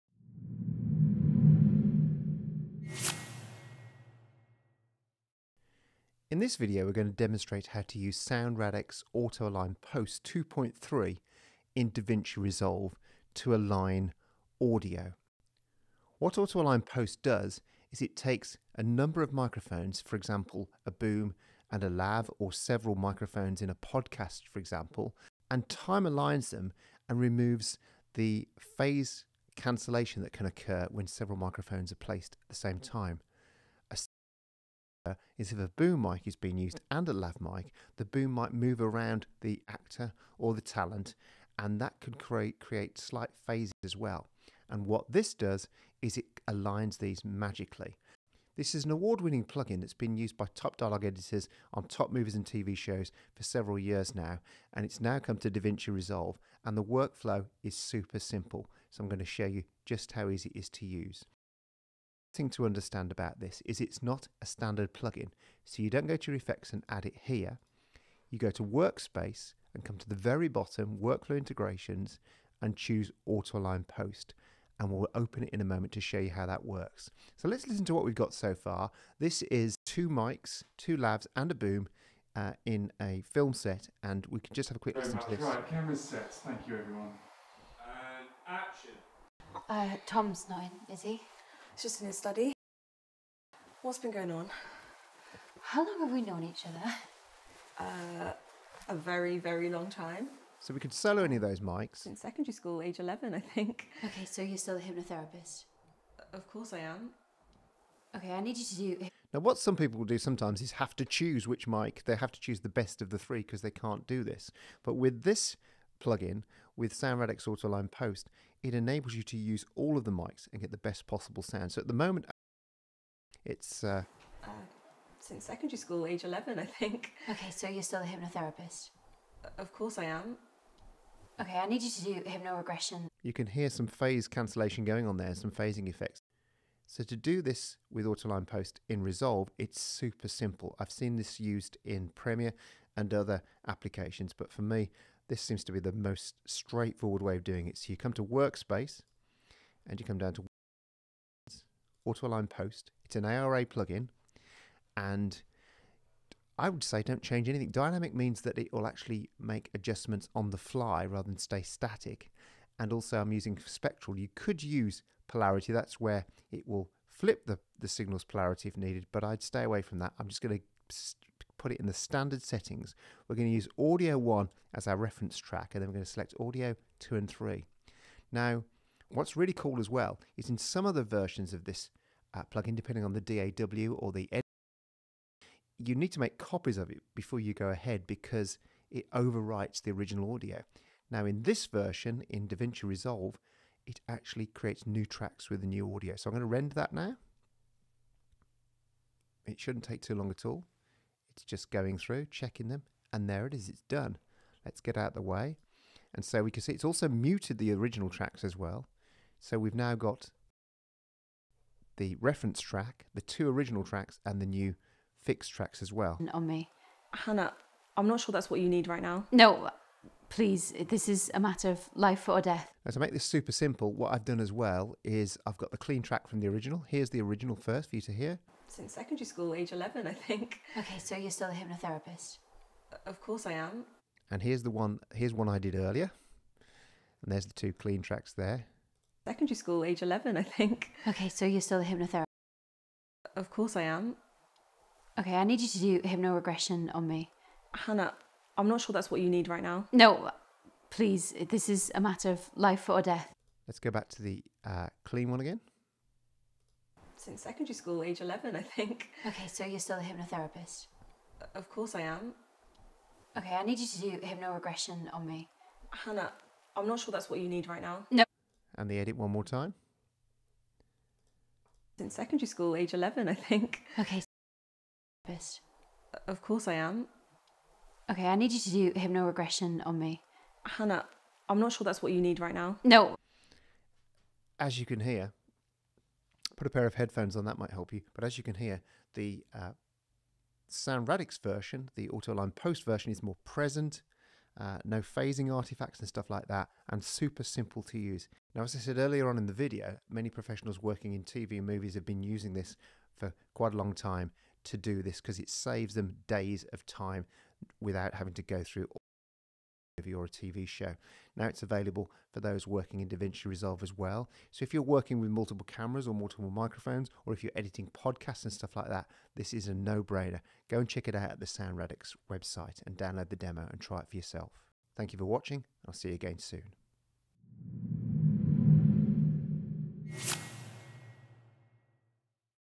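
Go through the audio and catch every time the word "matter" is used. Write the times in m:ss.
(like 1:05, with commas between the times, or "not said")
3:41, 4:12.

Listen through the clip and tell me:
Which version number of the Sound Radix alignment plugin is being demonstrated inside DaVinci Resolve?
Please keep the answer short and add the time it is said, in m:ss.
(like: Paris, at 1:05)
2.3, at 0:10.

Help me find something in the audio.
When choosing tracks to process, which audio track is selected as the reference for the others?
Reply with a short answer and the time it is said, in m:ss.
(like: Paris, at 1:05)
Audio 1, at 2:53.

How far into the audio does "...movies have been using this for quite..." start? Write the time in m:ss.
5:01.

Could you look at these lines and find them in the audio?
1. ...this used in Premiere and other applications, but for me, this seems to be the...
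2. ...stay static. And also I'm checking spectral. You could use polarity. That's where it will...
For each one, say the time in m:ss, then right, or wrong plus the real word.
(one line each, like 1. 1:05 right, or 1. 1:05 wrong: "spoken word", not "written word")
1. 2:21 right
2. 2:41 wrong: "using", not "checking".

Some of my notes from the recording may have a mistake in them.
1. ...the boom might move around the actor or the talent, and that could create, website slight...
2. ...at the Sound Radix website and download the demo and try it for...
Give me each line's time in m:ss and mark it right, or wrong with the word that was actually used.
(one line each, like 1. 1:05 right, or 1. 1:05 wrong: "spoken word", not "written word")
1. 0:37 wrong: "create", not "website"
2. 5:21 right.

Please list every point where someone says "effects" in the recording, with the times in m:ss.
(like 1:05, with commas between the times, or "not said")
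1:06, 2:15.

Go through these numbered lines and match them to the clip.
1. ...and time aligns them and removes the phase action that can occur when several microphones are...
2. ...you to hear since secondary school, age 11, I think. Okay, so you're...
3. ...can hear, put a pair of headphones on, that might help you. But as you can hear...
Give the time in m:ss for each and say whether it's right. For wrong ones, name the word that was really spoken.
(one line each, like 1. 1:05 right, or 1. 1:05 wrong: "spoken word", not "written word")
1. 0:25 wrong: "cancellation", not "action"
2. 3:47 right
3. 4:44 right.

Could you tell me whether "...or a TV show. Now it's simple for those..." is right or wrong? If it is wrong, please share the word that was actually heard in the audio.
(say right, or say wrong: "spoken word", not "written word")
wrong: "available", not "simple".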